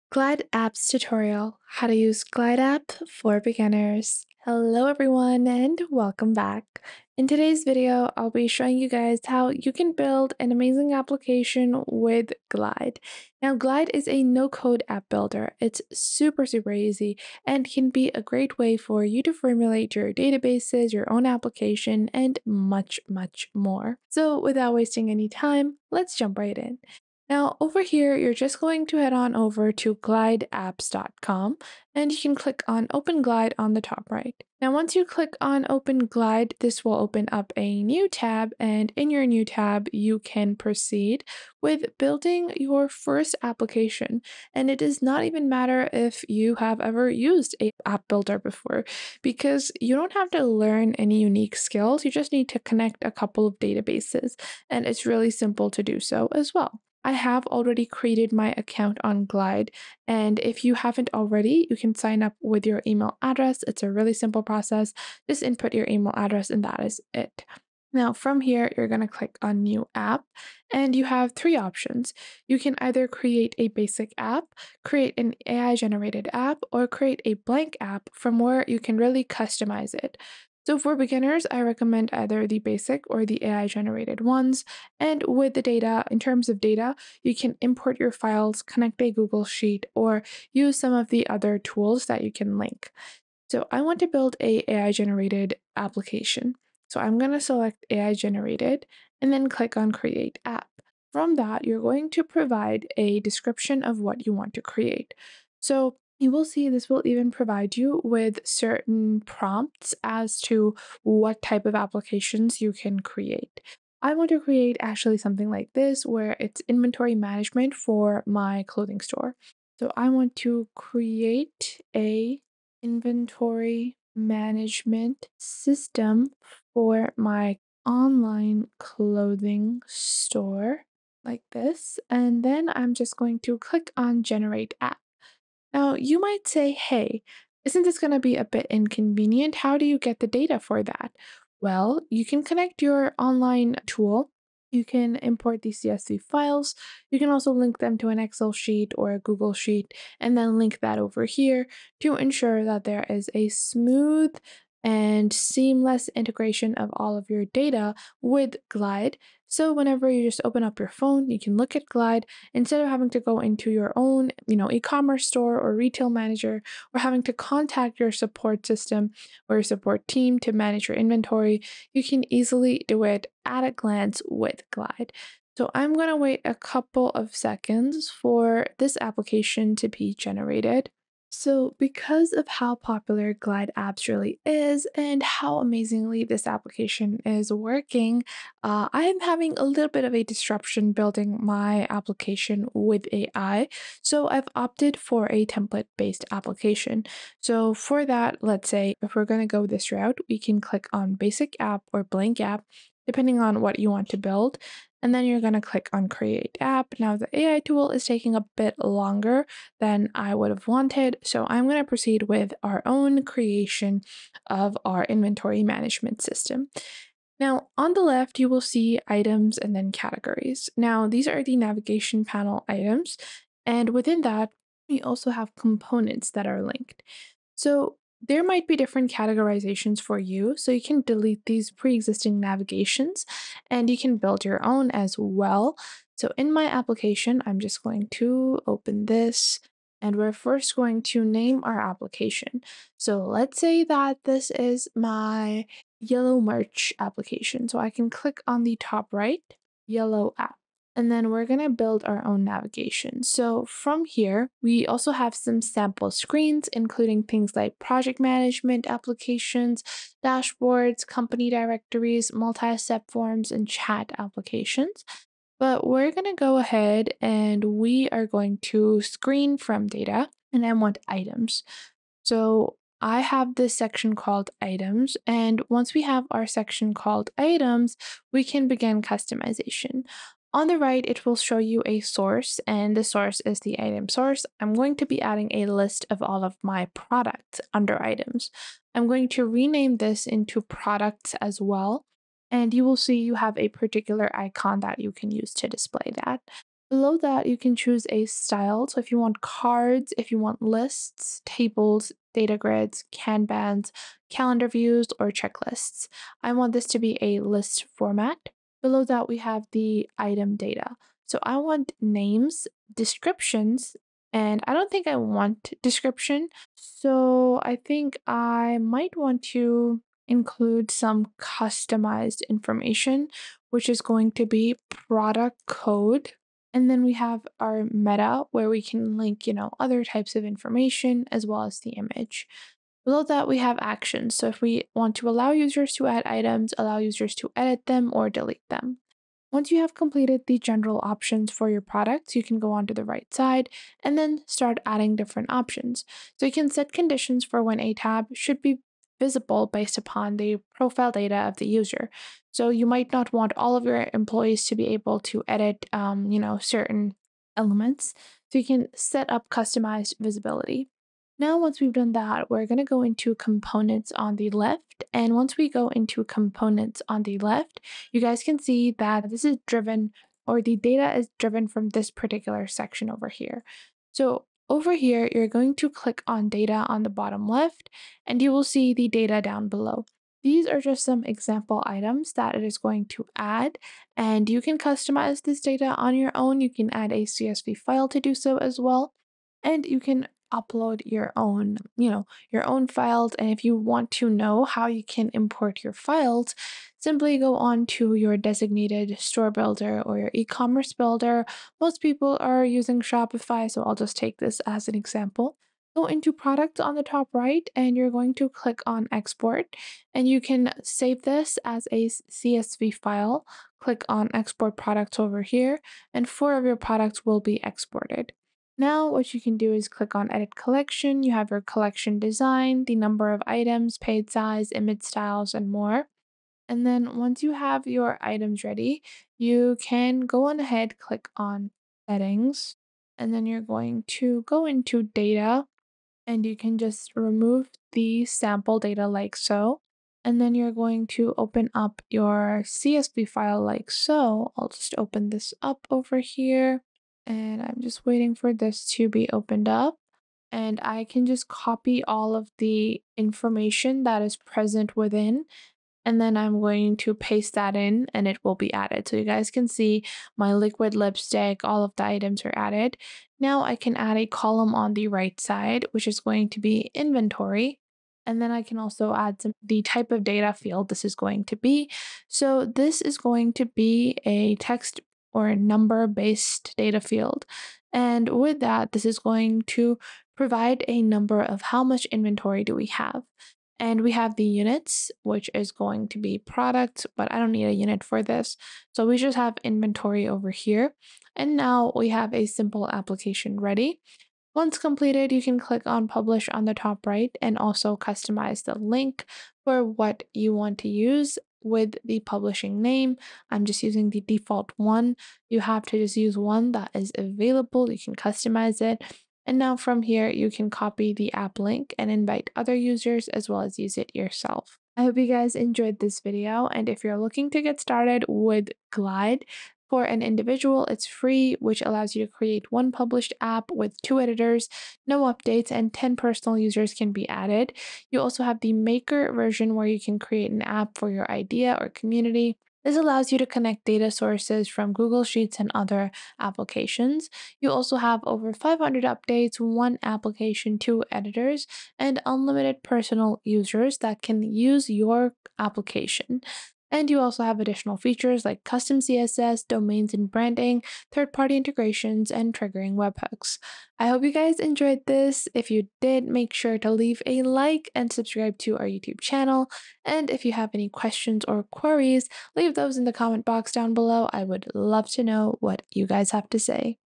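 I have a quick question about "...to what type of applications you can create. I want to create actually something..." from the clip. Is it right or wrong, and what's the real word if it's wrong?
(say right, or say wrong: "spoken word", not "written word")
right.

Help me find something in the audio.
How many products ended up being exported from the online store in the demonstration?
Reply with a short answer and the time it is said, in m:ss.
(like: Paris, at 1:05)
4, at 6:56.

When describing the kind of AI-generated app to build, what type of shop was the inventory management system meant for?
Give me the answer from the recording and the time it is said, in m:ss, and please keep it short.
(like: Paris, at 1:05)
Online clothing store, at 2:07.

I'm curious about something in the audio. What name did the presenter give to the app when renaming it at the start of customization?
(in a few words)
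Yellow merch.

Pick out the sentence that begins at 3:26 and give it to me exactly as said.
Now the AI tool is taking a bit longer than I would have wanted.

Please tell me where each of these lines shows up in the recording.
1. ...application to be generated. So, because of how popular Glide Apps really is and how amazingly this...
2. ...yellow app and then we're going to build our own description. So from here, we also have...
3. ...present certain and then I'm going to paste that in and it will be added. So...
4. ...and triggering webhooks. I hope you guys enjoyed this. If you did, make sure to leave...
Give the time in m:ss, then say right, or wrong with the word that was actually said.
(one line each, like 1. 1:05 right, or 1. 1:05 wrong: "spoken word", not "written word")
1. 2:59 right
2. 4:09 wrong: "navigation", not "description"
3. 7:34 wrong: "within", not "certain"
4. 9:12 right.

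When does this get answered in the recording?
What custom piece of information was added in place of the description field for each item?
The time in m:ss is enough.
5:24.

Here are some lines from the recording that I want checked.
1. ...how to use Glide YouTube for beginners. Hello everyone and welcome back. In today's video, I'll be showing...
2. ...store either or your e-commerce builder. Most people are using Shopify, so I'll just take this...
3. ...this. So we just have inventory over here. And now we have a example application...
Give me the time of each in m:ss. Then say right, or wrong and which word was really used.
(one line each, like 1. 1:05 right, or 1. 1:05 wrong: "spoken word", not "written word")
1. 0:01 wrong: "App", not "YouTube"
2. 6:39 wrong: "builder", not "either"
3. 8:08 wrong: "simple", not "example".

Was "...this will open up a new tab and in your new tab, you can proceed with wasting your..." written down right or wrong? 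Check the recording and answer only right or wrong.
wrong.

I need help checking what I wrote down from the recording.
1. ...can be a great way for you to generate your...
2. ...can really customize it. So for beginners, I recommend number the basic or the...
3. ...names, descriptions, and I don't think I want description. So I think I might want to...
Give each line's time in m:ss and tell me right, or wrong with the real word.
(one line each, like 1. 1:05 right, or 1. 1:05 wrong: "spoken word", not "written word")
1. 0:17 wrong: "formulate", not "generate"
2. 1:18 wrong: "either", not "number"
3. 5:12 right.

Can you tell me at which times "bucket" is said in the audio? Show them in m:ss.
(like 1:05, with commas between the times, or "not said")
not said.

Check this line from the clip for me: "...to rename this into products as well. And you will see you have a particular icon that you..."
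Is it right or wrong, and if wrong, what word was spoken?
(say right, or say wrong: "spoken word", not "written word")
right.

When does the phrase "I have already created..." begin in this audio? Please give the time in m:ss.
0:57.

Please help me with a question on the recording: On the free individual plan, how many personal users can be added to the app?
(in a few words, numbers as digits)
10.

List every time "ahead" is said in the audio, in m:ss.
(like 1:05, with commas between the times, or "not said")
4:26, 7:10.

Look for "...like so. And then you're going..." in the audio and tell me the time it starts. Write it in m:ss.
7:19.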